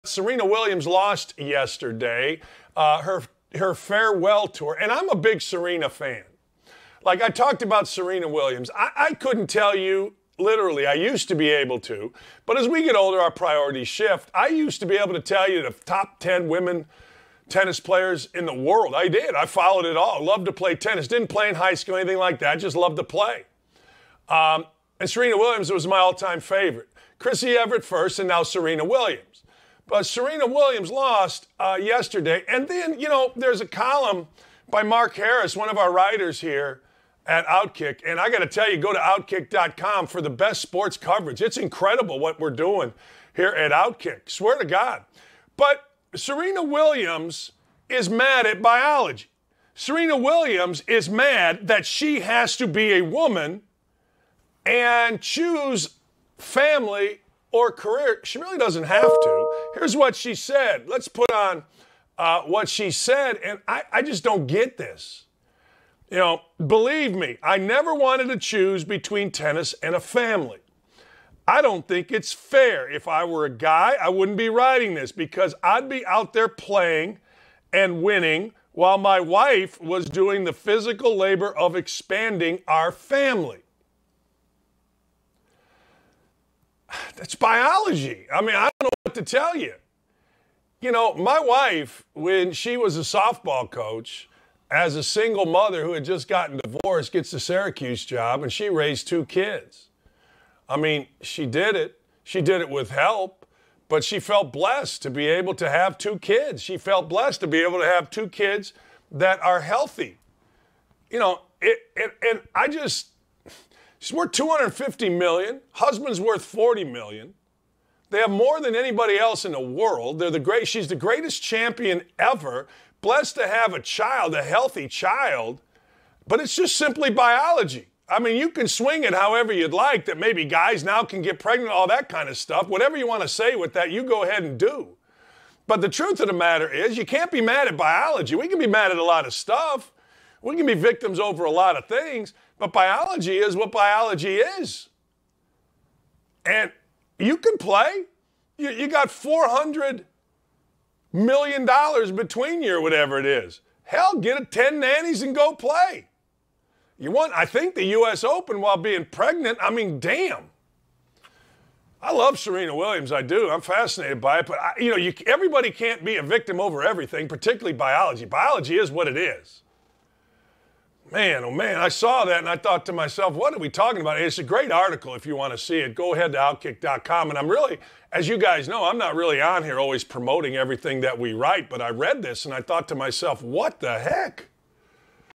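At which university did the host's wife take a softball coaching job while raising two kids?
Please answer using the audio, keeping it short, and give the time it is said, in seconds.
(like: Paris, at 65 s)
Syracuse, at 97 s.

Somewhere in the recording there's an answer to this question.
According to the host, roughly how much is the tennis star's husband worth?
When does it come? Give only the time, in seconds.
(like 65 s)
116 s.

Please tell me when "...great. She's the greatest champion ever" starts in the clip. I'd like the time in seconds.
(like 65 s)
120 s.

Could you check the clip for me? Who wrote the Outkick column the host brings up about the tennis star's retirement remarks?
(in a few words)
Mark Harris.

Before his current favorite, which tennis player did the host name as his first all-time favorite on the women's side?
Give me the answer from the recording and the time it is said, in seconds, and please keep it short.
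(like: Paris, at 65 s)
Chrissie Evert, at 27 s.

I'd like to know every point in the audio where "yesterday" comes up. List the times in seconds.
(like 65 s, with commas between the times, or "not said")
1 s, 31 s.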